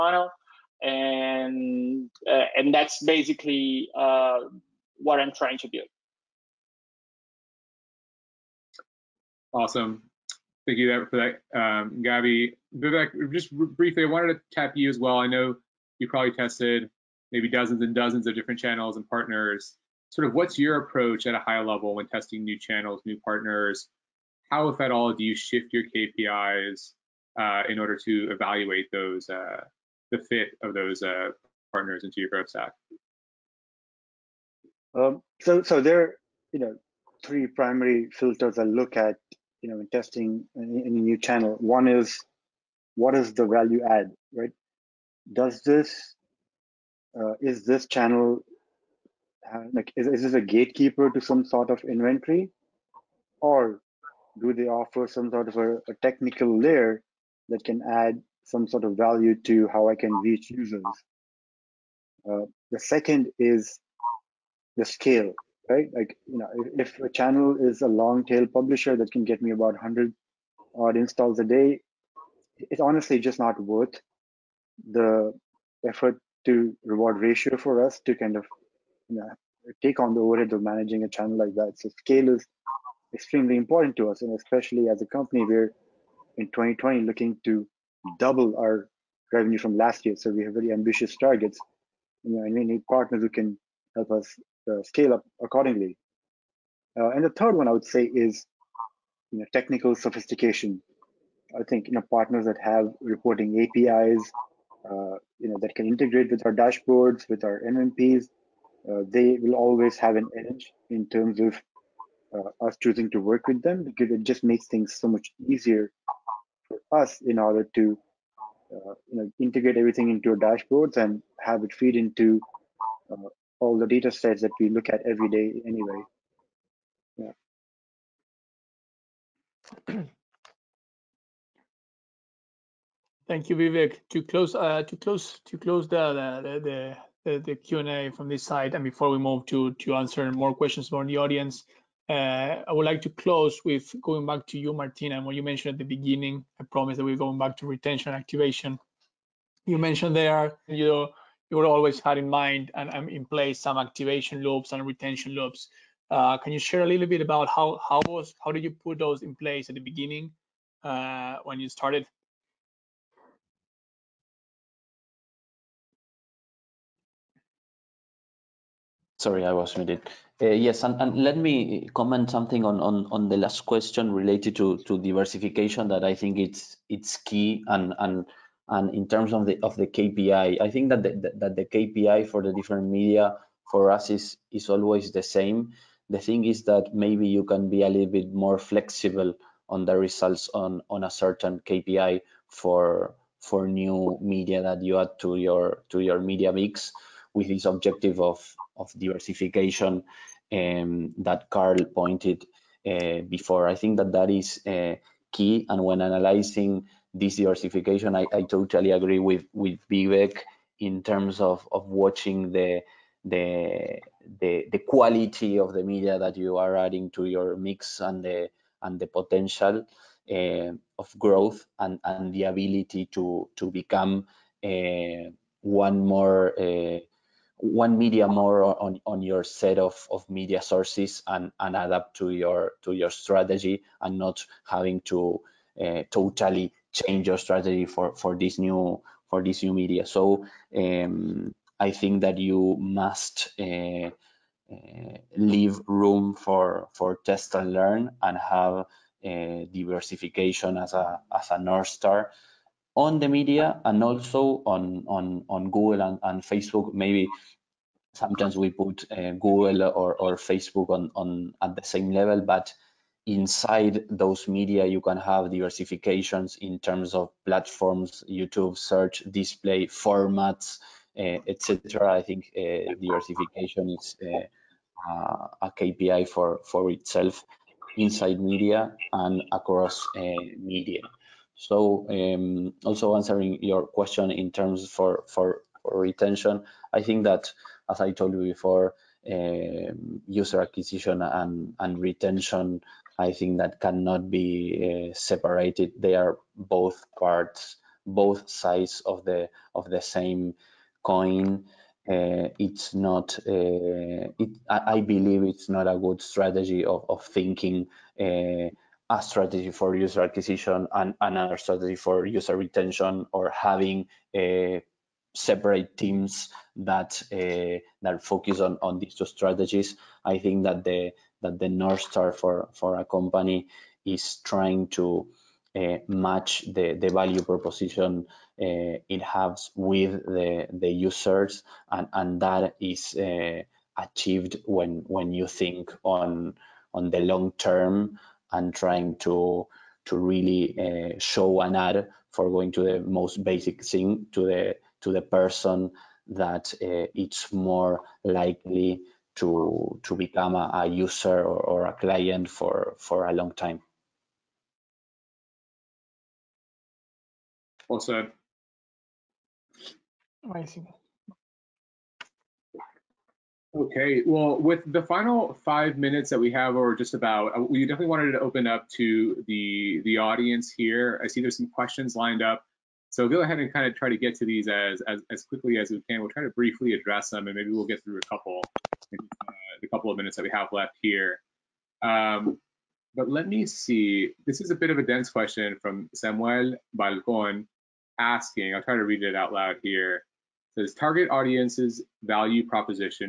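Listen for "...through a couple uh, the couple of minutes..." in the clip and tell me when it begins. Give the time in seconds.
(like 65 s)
378 s.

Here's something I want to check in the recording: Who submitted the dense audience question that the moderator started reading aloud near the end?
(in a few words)
Samuel Balcon.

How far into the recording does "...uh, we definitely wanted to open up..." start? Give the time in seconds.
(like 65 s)
367 s.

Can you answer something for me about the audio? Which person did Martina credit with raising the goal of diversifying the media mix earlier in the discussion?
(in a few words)
Carl.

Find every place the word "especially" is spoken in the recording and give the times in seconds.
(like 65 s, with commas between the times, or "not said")
84 s.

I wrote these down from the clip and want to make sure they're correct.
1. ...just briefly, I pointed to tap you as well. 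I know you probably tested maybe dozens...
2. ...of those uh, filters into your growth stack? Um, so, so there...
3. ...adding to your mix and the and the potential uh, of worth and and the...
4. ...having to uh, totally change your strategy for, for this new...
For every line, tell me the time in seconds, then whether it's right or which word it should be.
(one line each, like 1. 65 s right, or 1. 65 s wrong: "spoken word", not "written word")
1. 13 s wrong: "wanted", not "pointed"
2. 30 s wrong: "partners", not "filters"
3. 216 s wrong: "growth", not "worth"
4. 234 s right.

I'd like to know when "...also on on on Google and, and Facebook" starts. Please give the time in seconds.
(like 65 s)
254 s.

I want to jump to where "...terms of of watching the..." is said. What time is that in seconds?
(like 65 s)
211 s.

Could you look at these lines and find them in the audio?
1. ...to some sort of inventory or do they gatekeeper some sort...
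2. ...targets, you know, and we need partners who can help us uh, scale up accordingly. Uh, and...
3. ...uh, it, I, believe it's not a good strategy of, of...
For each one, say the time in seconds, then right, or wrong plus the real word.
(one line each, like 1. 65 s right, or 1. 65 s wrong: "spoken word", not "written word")
1. 51 s wrong: "offer", not "gatekeeper"
2. 91 s right
3. 303 s right.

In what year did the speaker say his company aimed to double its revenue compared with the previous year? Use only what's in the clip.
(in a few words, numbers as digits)
2020.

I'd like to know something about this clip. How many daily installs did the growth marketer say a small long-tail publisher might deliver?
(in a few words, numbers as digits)
100.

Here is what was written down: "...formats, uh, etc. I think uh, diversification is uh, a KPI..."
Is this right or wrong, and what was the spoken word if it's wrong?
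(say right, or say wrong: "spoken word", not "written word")
right.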